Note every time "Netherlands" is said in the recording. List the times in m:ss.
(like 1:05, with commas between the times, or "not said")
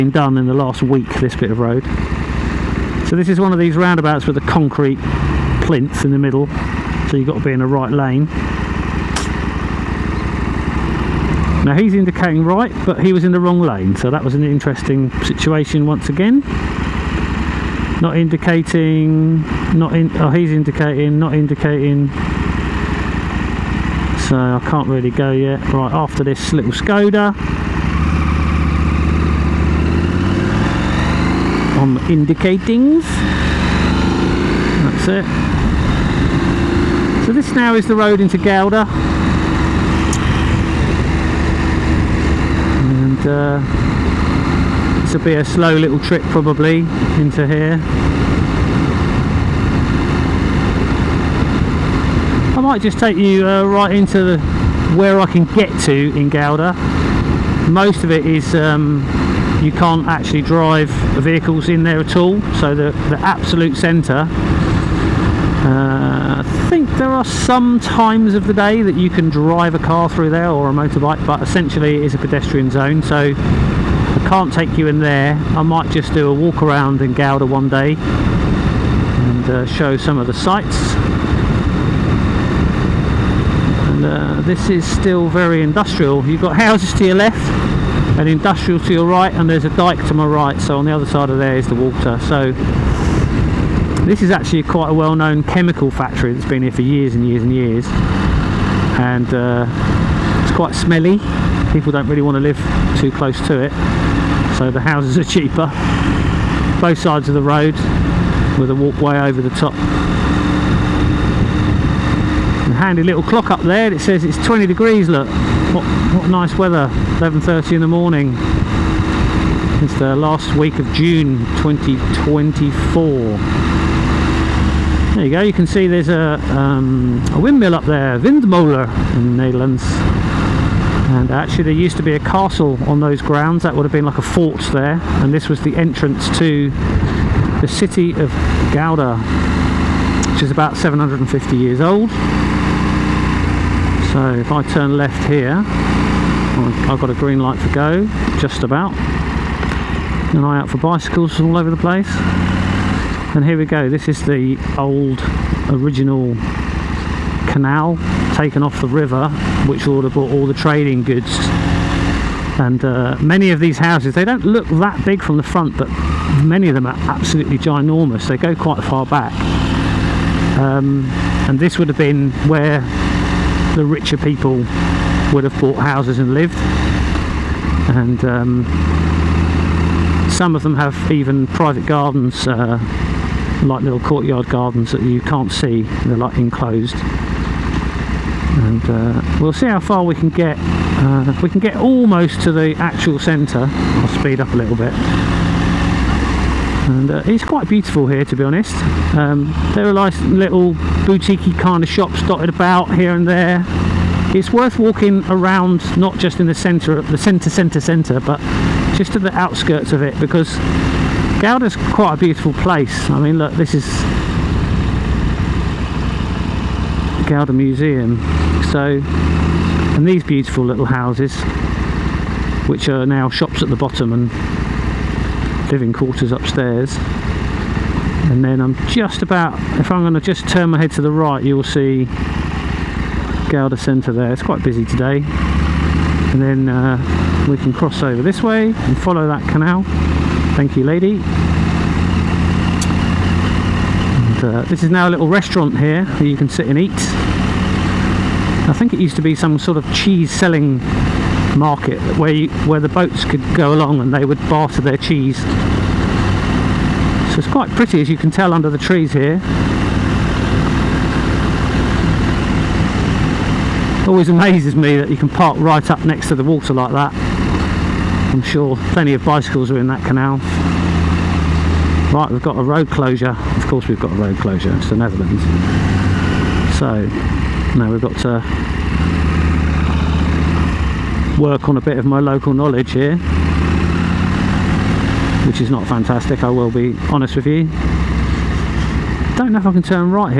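2:09, 4:34.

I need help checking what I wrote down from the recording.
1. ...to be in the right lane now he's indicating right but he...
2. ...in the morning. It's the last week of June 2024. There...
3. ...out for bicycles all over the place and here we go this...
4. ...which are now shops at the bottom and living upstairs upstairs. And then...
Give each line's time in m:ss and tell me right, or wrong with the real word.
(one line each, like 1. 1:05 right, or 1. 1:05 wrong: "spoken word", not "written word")
1. 0:07 right
2. 1:57 right
3. 2:30 right
4. 3:42 wrong: "quarters", not "upstairs".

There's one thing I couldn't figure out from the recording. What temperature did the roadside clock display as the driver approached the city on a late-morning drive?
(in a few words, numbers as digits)
20 degrees.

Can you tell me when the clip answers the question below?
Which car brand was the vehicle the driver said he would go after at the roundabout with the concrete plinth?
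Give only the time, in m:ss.
0:26.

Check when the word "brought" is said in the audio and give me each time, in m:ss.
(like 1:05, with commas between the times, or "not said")
2:40.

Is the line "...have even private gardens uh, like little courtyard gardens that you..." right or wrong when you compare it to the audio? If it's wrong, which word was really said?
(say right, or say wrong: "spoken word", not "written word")
right.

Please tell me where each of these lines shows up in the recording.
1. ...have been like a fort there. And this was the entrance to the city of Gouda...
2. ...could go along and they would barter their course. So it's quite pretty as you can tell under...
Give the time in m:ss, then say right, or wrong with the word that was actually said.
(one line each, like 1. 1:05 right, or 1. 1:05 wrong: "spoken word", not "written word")
1. 2:13 right
2. 4:13 wrong: "cheese", not "course".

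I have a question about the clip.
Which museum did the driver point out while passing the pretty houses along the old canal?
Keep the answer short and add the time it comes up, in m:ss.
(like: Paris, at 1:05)
Gouda Museum, at 3:37.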